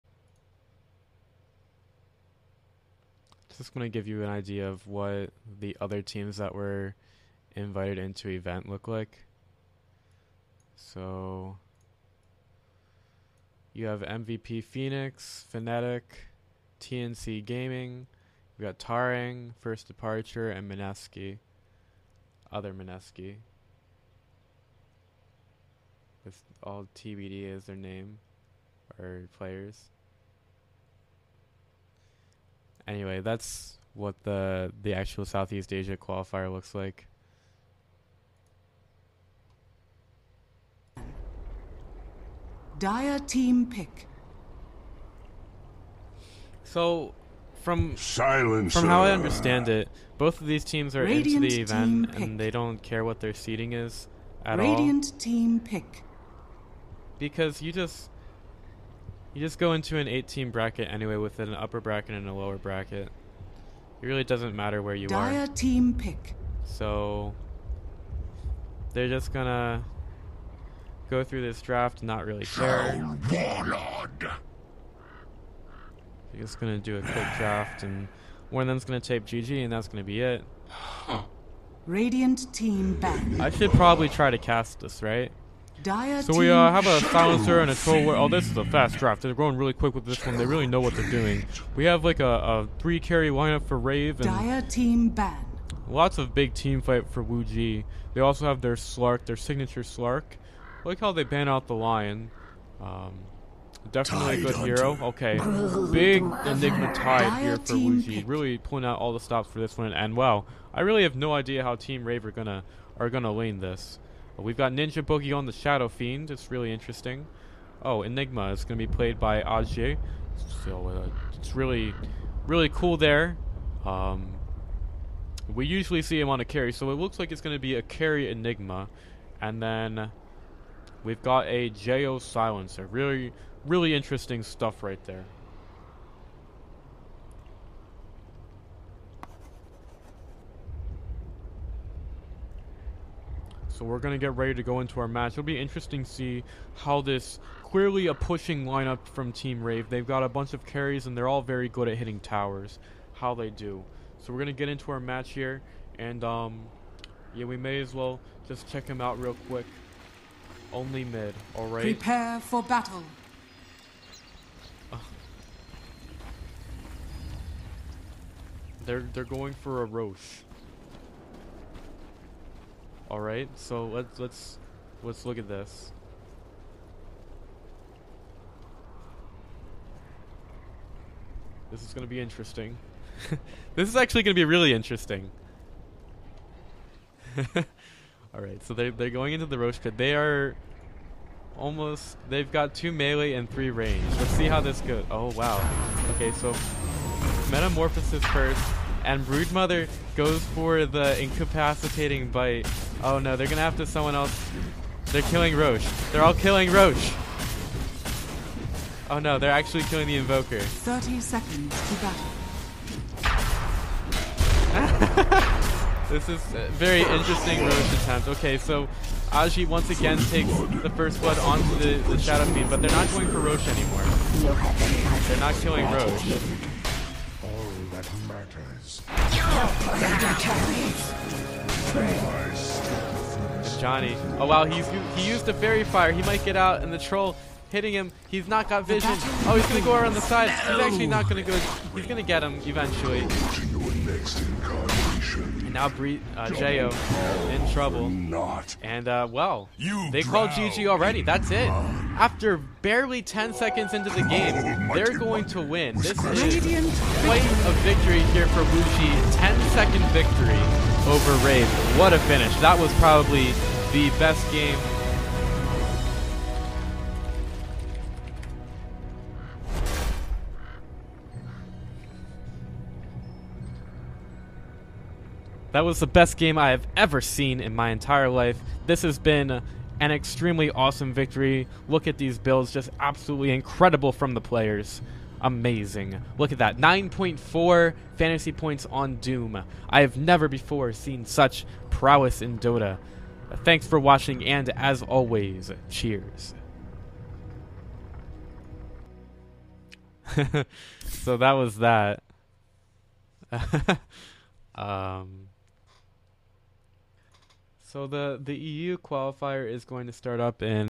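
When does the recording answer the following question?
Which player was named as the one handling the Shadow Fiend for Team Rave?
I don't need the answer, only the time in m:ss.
1:54.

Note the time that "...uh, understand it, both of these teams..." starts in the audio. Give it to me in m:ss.
0:49.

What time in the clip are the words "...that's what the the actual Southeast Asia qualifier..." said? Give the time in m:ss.
0:33.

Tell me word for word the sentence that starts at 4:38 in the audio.
This has been an extremely awesome victory.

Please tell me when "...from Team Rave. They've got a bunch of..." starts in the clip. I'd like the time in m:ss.
2:29.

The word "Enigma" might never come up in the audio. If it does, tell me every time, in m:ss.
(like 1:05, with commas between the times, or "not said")
1:46, 1:58, 2:08.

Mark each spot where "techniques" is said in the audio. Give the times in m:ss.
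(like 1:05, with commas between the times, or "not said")
not said.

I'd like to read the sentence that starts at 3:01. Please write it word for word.
This is going to be interesting.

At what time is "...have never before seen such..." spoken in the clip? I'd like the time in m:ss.
4:50.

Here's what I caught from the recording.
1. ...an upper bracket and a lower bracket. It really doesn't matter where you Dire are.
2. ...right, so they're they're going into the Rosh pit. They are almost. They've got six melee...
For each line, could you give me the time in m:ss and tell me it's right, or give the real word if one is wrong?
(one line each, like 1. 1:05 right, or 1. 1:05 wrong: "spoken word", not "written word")
1. 1:01 right
2. 3:08 wrong: "two", not "six".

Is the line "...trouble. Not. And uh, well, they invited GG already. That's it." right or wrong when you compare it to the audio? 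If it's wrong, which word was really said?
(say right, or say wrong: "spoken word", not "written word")
wrong: "called", not "invited".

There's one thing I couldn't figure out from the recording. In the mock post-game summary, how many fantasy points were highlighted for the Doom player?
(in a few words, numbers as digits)
9.4.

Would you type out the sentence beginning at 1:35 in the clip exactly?
Lots of big team fight for WuJie.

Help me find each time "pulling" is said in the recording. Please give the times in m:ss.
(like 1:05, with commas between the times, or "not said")
1:48.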